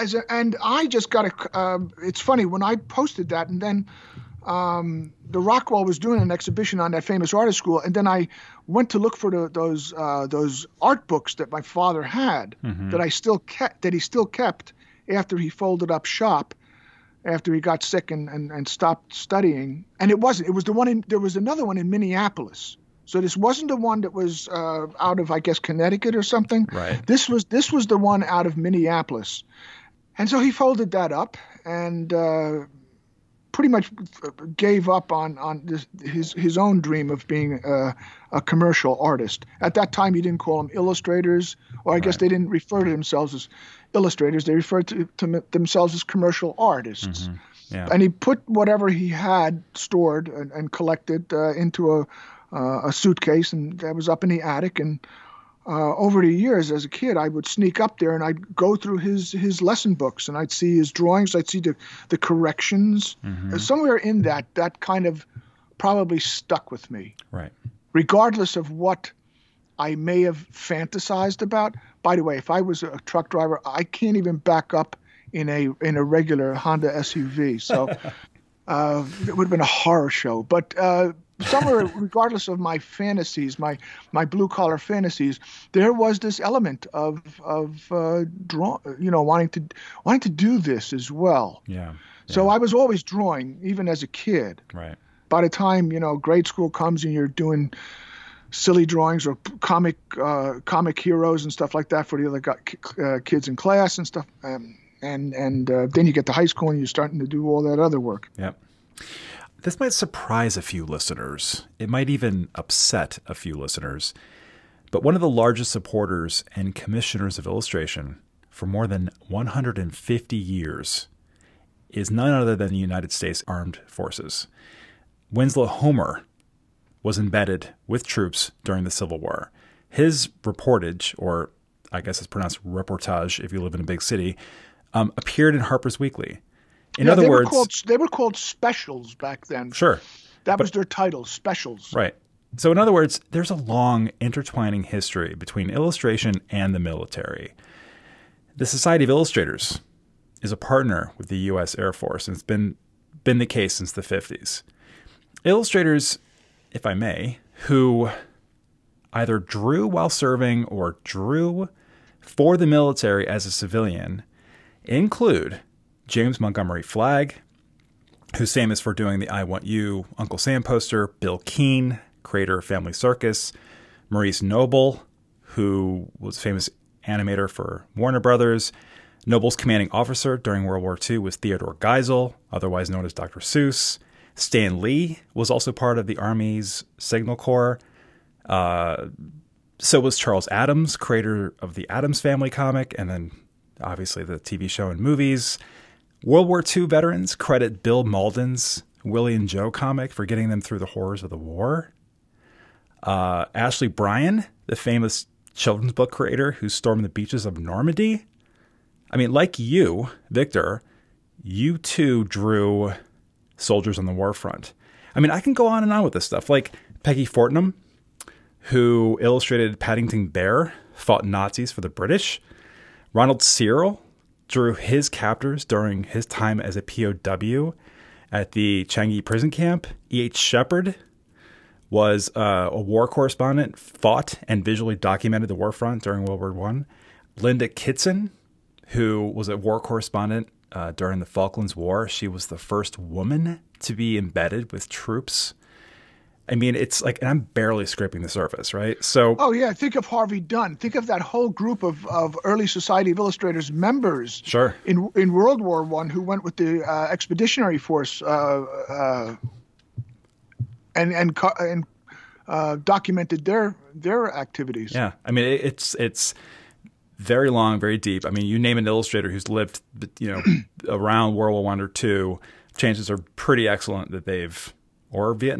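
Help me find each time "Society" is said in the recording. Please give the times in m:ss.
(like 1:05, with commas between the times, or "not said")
2:28, 4:12.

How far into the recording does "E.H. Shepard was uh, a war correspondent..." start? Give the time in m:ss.
3:50.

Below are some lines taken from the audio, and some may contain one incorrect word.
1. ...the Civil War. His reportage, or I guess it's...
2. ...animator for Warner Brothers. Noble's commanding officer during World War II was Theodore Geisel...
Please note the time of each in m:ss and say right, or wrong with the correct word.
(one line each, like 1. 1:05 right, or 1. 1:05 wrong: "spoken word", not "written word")
1. 2:08 right
2. 2:57 right.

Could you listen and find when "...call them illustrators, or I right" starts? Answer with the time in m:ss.
0:40.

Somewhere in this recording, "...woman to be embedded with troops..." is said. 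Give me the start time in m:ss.
4:02.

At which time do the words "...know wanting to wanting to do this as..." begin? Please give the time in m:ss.
1:29.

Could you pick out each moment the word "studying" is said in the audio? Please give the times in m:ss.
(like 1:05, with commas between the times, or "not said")
0:19.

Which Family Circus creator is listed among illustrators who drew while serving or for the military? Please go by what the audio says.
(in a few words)
Bill Keane.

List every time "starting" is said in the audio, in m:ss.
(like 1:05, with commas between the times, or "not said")
1:46.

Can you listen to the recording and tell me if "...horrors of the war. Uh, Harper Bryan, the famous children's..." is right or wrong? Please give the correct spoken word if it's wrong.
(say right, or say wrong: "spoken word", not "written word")
wrong: "Ashley", not "Harper".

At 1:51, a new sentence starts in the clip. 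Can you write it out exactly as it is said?
It might even upset a few listeners.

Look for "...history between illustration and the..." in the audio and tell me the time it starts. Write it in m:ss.
2:24.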